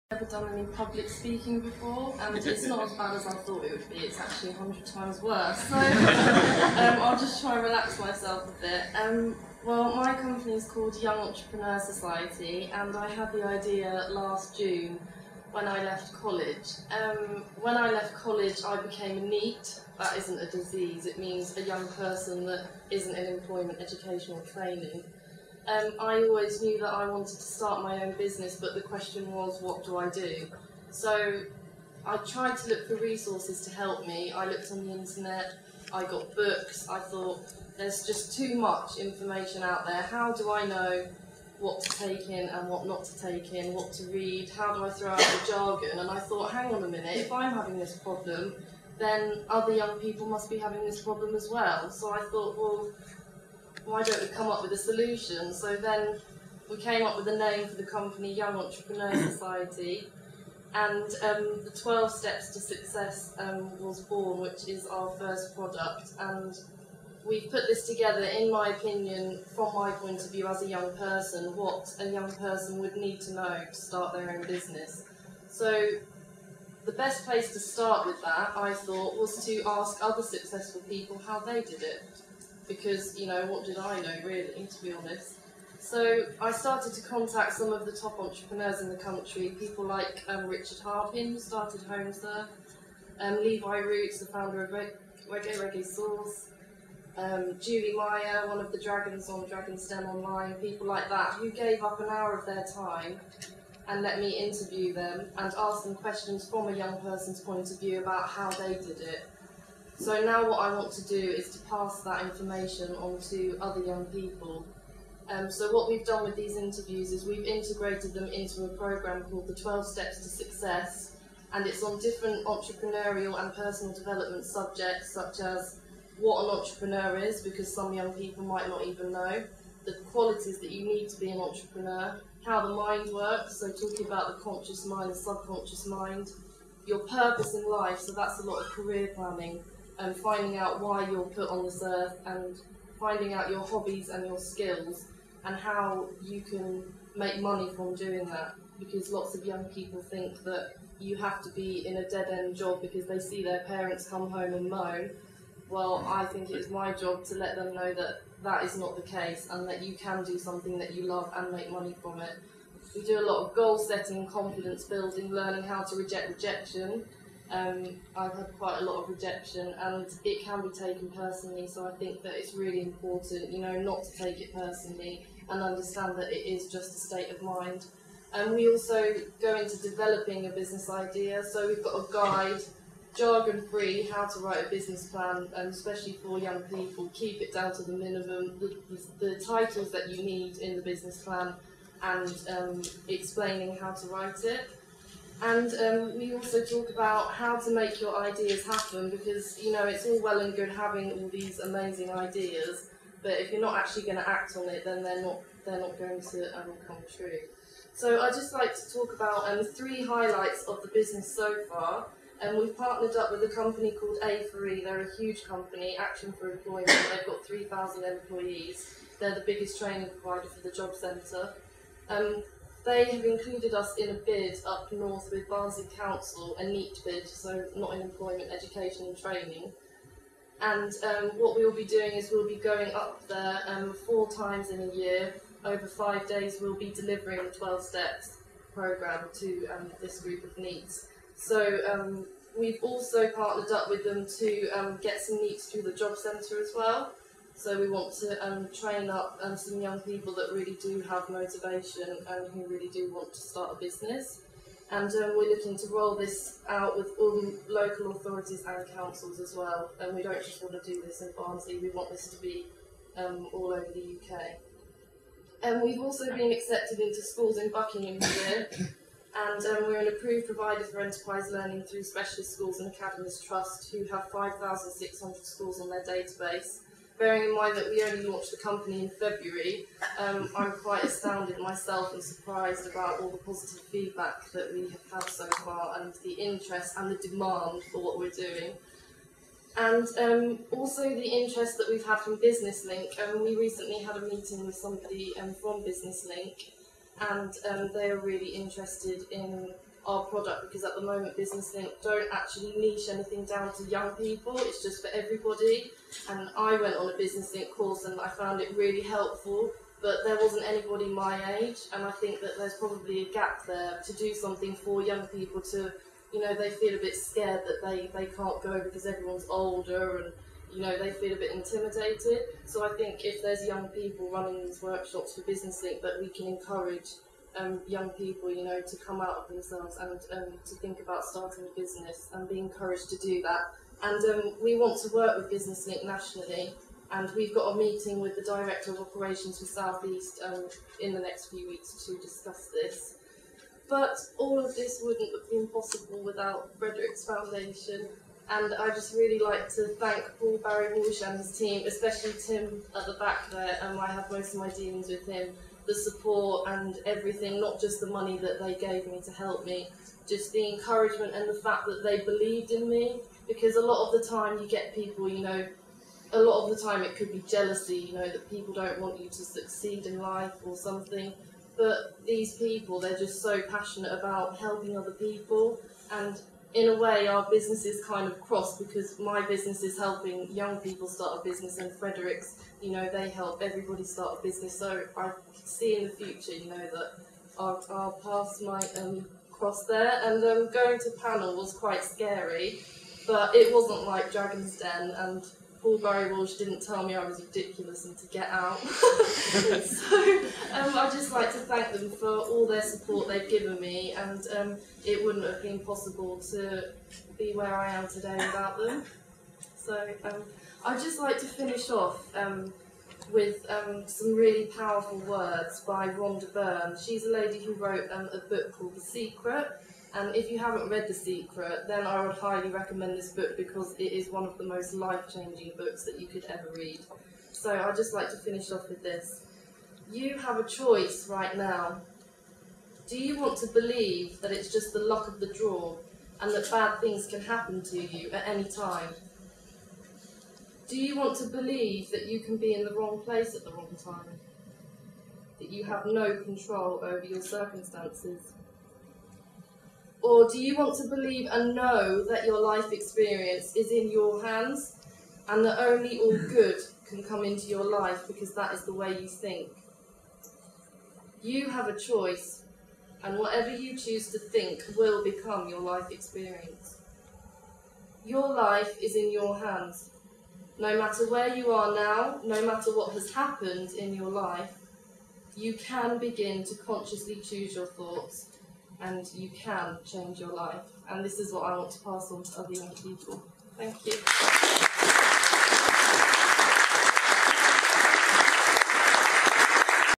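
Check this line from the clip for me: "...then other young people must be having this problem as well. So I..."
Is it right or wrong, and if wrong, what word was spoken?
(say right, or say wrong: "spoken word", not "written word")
right.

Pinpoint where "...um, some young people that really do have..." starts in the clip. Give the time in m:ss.
4:09.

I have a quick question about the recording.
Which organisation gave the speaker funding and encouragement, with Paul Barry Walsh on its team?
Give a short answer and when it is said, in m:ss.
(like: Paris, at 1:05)
Frederick's Foundation, at 5:46.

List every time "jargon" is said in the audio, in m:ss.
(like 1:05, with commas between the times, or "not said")
0:45, 3:03.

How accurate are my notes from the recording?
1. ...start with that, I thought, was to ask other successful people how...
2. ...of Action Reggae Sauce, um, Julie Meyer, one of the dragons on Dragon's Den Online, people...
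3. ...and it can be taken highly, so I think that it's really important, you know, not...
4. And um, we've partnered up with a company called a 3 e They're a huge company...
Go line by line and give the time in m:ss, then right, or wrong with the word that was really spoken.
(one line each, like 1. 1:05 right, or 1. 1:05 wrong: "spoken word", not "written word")
1. 1:17 right
2. 1:34 wrong: "Reggae", not "Action"
3. 2:49 wrong: "personally", not "highly"
4. 3:32 right.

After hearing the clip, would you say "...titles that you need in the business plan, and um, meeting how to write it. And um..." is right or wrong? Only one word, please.
wrong.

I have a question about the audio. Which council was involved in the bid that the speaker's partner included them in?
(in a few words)
Barnsley Council.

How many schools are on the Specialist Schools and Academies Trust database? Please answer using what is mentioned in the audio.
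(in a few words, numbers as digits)
5,600.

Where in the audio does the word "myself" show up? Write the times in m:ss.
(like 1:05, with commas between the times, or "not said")
0:07, 4:41.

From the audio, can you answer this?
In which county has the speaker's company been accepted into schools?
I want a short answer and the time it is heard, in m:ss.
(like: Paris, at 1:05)
Buckinghamshire, at 4:27.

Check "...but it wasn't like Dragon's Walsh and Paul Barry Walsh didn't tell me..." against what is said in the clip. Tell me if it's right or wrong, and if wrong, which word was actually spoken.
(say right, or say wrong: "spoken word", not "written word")
wrong: "Den", not "Walsh".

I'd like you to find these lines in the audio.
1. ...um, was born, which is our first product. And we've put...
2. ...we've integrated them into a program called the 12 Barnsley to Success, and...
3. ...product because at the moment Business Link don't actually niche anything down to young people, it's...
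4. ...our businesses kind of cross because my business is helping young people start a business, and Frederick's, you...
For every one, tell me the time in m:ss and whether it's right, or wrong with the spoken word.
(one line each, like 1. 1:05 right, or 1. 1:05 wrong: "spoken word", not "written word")
1. 1:03 right
2. 1:57 wrong: "Steps", not "Barnsley"
3. 5:00 right
4. 6:17 right.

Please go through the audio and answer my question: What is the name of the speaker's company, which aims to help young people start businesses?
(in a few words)
Young Entrepreneur Society.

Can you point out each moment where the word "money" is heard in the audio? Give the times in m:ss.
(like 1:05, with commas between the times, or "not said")
2:27, 2:41, 5:58.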